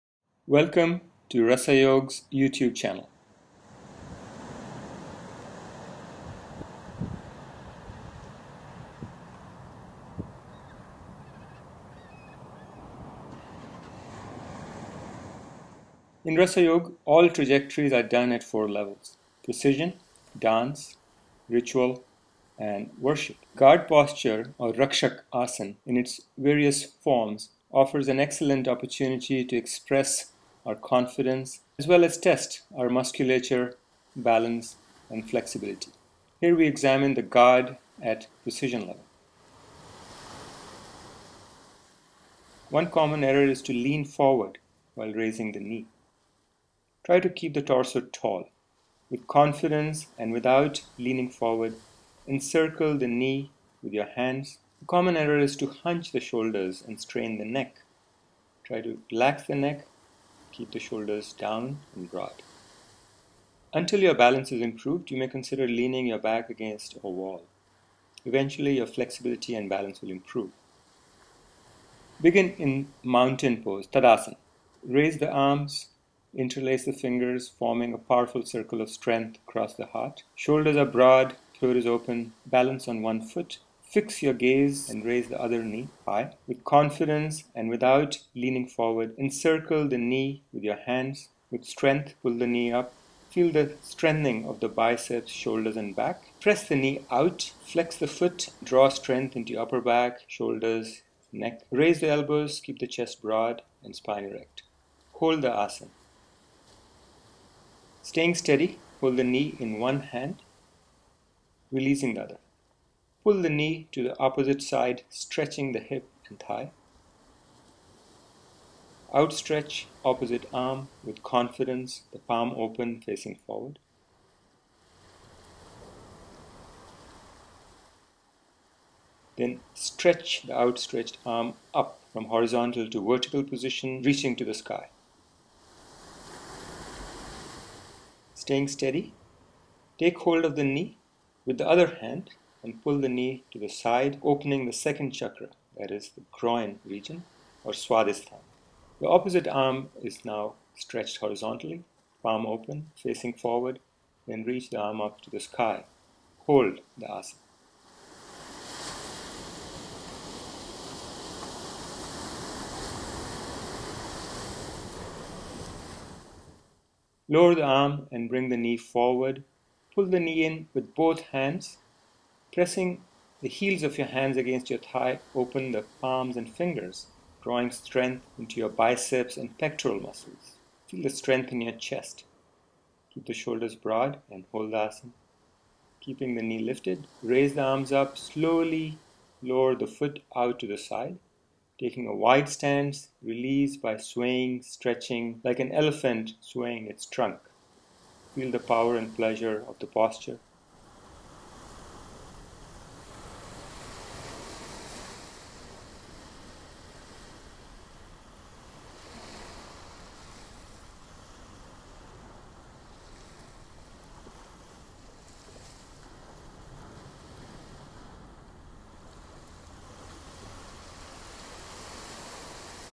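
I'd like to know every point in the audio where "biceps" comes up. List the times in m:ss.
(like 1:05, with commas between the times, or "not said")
1:34, 2:58.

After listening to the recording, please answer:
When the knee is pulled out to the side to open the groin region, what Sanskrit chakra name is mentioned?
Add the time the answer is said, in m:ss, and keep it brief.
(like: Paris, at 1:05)
Swadhisthana, at 2:27.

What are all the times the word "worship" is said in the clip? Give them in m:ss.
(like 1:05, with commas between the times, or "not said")
0:22.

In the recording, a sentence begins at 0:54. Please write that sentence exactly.
The common error is to hunch the shoulders and strain the neck.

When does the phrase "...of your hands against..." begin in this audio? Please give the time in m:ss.
2:53.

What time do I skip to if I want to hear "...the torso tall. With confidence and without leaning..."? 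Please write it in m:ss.
0:47.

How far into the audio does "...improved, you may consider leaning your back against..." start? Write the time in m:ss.
1:04.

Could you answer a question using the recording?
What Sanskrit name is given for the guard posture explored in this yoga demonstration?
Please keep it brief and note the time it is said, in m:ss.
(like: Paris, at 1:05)
Rakshak Asana, at 0:24.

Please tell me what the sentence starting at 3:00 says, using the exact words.
Feel the strength in your chest.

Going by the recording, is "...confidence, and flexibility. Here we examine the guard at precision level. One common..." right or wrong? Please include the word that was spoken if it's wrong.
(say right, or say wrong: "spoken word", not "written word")
wrong: "balance", not "confidence".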